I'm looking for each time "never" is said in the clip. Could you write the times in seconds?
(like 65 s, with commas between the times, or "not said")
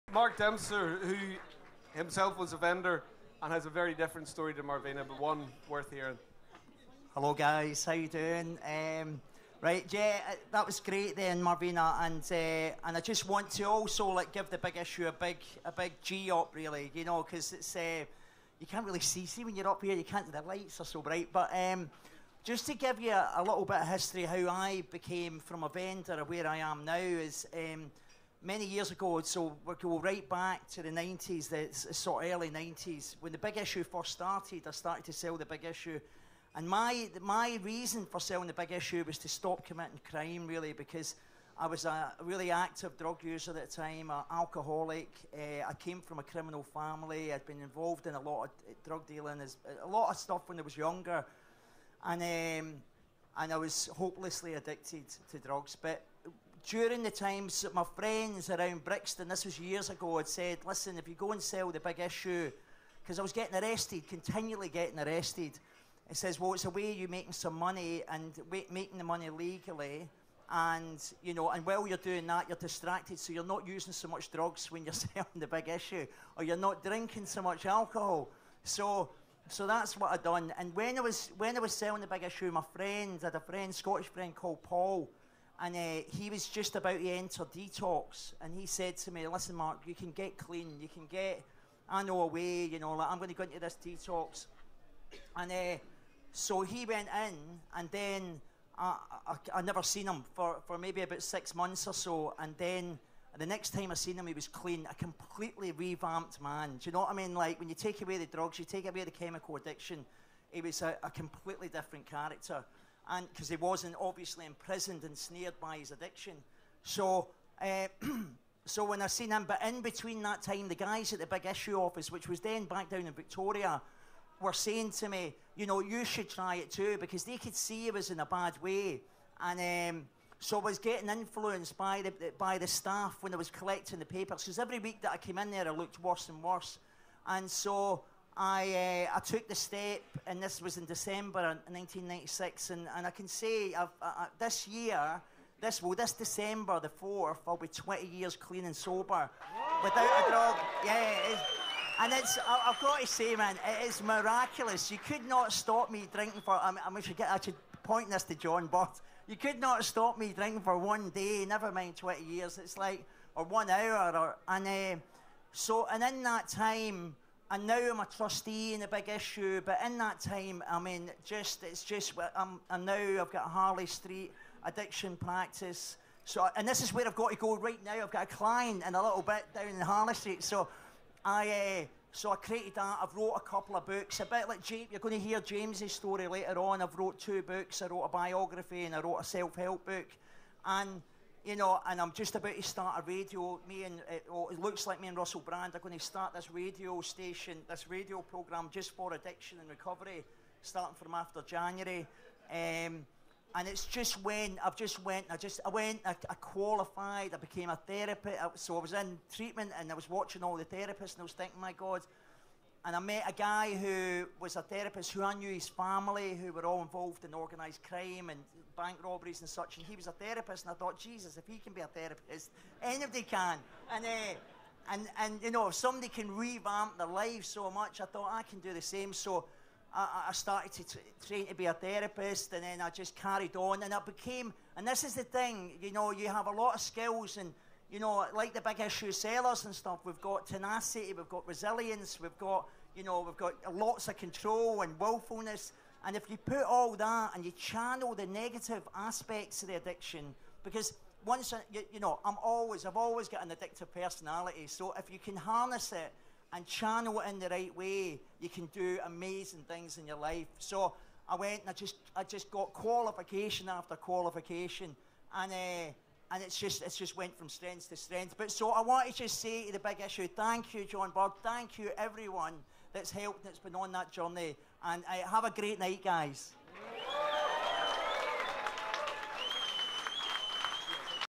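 99 s, 161 s.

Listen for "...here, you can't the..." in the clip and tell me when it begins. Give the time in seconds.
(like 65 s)
19 s.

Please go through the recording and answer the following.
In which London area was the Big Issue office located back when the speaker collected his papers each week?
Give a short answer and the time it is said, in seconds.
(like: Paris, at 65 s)
Victoria, at 123 s.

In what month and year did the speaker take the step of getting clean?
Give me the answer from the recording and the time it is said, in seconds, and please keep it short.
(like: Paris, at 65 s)
December 1996, at 140 s.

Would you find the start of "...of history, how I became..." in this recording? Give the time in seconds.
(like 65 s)
23 s.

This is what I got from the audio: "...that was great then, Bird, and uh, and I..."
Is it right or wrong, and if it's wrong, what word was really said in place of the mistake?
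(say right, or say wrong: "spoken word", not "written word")
wrong: "Marvina", not "Bird".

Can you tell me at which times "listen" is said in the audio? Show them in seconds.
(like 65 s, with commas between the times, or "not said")
60 s, 89 s.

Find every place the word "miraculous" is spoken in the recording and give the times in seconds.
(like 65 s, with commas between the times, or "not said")
154 s.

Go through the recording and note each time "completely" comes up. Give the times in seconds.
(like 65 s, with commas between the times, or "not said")
104 s, 111 s.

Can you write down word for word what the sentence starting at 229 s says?
So I, I started to t- train to be a therapist, and then I just carried on, and it became.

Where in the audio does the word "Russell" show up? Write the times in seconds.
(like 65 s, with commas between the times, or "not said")
195 s.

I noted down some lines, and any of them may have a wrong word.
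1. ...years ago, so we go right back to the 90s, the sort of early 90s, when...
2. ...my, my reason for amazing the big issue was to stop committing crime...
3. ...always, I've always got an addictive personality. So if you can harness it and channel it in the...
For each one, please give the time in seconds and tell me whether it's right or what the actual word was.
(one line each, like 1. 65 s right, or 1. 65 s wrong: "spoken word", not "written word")
1. 28 s right
2. 36 s wrong: "selling", not "amazing"
3. 252 s right.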